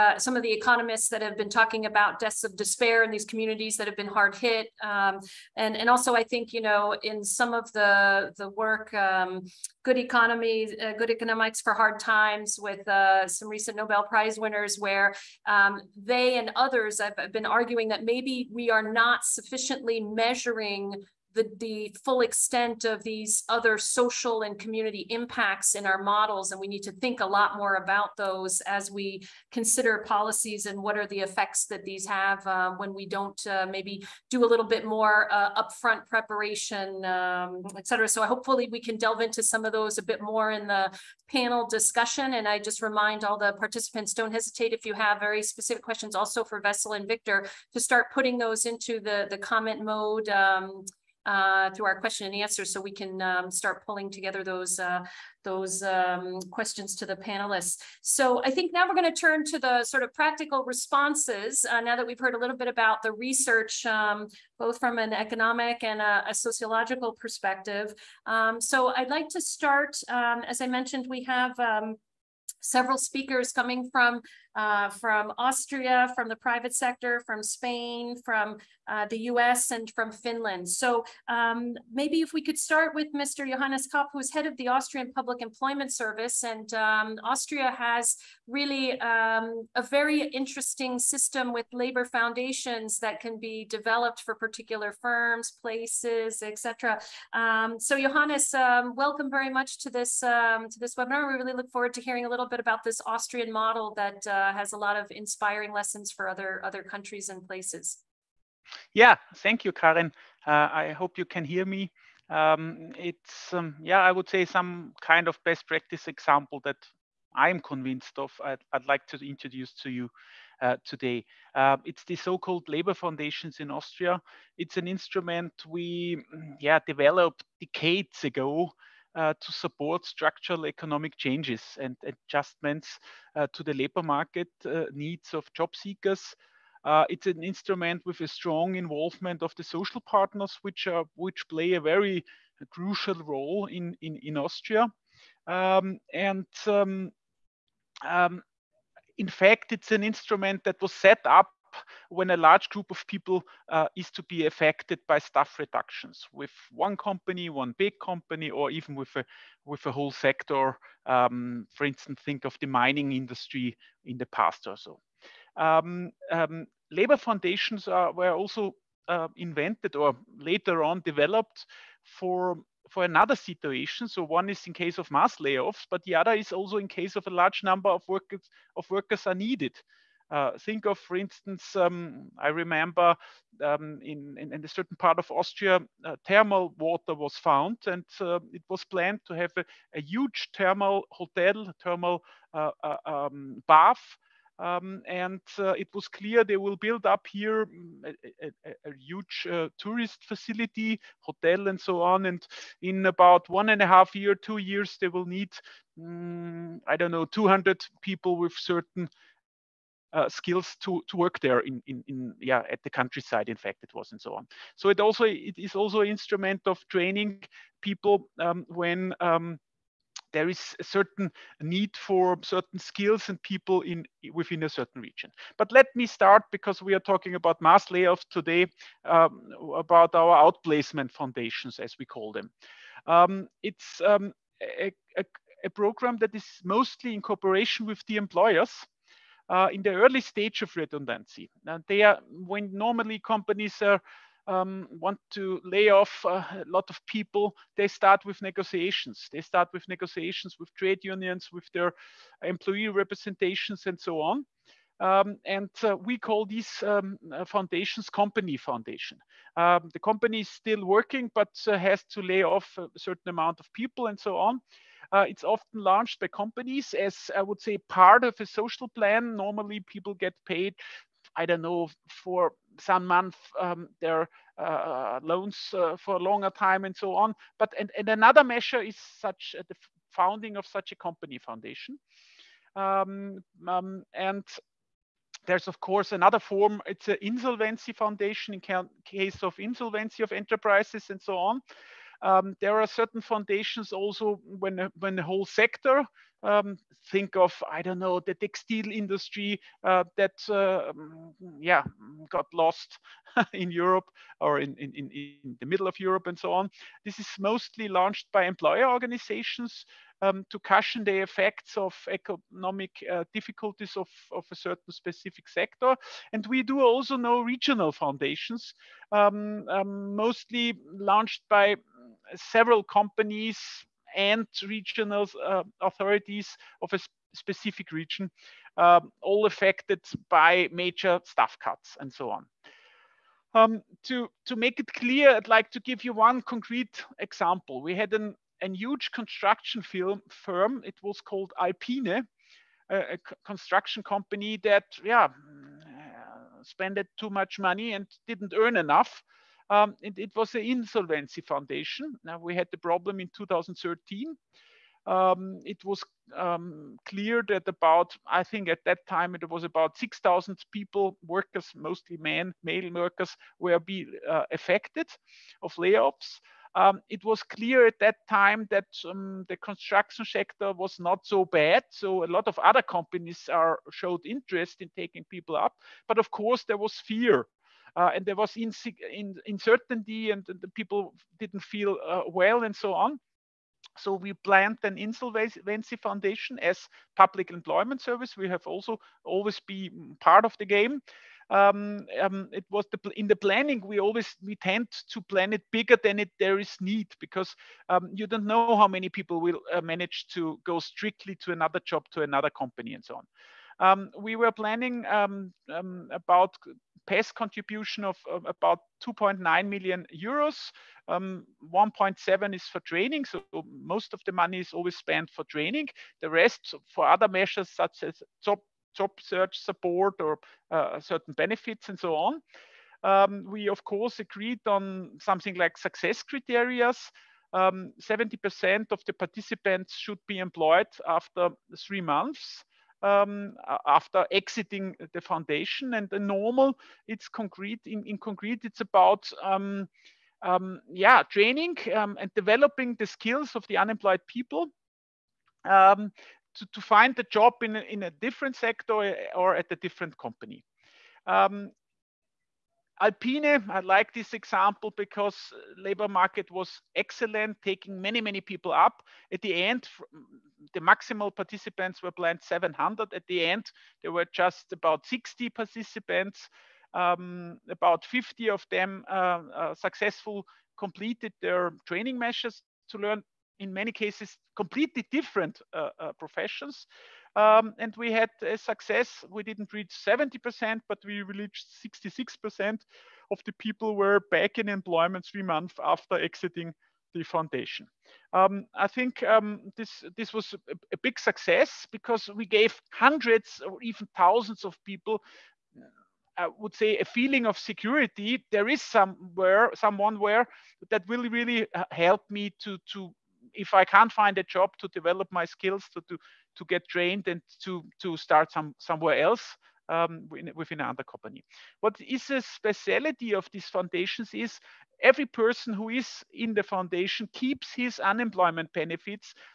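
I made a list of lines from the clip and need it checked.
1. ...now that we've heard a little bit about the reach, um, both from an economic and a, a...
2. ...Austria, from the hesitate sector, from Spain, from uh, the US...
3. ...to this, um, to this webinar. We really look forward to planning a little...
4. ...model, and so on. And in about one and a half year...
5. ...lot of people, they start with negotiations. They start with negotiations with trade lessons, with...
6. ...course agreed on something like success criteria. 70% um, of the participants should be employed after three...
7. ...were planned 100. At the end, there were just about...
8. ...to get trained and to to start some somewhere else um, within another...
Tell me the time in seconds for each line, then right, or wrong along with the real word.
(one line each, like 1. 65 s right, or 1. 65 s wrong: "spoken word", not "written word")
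1. 61 s wrong: "research", not "reach"
2. 75 s wrong: "private", not "hesitate"
3. 99 s wrong: "hearing", not "planning"
4. 201 s wrong: "hotel", not "model"
5. 246 s wrong: "unions", not "lessons"
6. 423 s right
7. 462 s wrong: "700", not "100"
8. 506 s right.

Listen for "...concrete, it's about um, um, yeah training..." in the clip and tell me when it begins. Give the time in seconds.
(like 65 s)
438 s.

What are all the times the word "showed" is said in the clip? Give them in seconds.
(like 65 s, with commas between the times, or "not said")
373 s.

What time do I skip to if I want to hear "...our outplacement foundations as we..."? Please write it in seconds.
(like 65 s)
230 s.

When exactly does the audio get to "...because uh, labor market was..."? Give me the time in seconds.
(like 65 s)
454 s.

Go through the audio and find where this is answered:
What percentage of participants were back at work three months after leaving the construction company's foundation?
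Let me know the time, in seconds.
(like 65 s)
481 s.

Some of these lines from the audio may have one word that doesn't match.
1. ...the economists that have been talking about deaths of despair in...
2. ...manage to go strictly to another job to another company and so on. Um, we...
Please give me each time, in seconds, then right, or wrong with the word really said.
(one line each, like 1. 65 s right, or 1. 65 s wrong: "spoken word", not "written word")
1. 0 s right
2. 399 s right.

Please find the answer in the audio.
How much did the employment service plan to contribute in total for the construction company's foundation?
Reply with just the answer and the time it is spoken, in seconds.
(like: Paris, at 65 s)
2.9 million euros, at 409 s.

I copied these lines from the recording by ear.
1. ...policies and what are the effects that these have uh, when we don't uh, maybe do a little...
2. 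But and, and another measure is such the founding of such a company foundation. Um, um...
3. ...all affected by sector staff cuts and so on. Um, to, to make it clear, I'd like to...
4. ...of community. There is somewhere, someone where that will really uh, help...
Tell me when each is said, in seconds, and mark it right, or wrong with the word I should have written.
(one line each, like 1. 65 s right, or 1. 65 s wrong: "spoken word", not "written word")
1. 30 s right
2. 277 s right
3. 329 s wrong: "major", not "sector"
4. 497 s wrong: "security", not "community".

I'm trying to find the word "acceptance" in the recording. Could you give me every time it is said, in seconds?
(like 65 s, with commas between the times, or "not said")
not said.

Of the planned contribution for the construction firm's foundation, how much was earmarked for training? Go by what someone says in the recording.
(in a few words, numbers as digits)
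1.7 million.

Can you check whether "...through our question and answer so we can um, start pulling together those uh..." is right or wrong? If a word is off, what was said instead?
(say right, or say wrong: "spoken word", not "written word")
right.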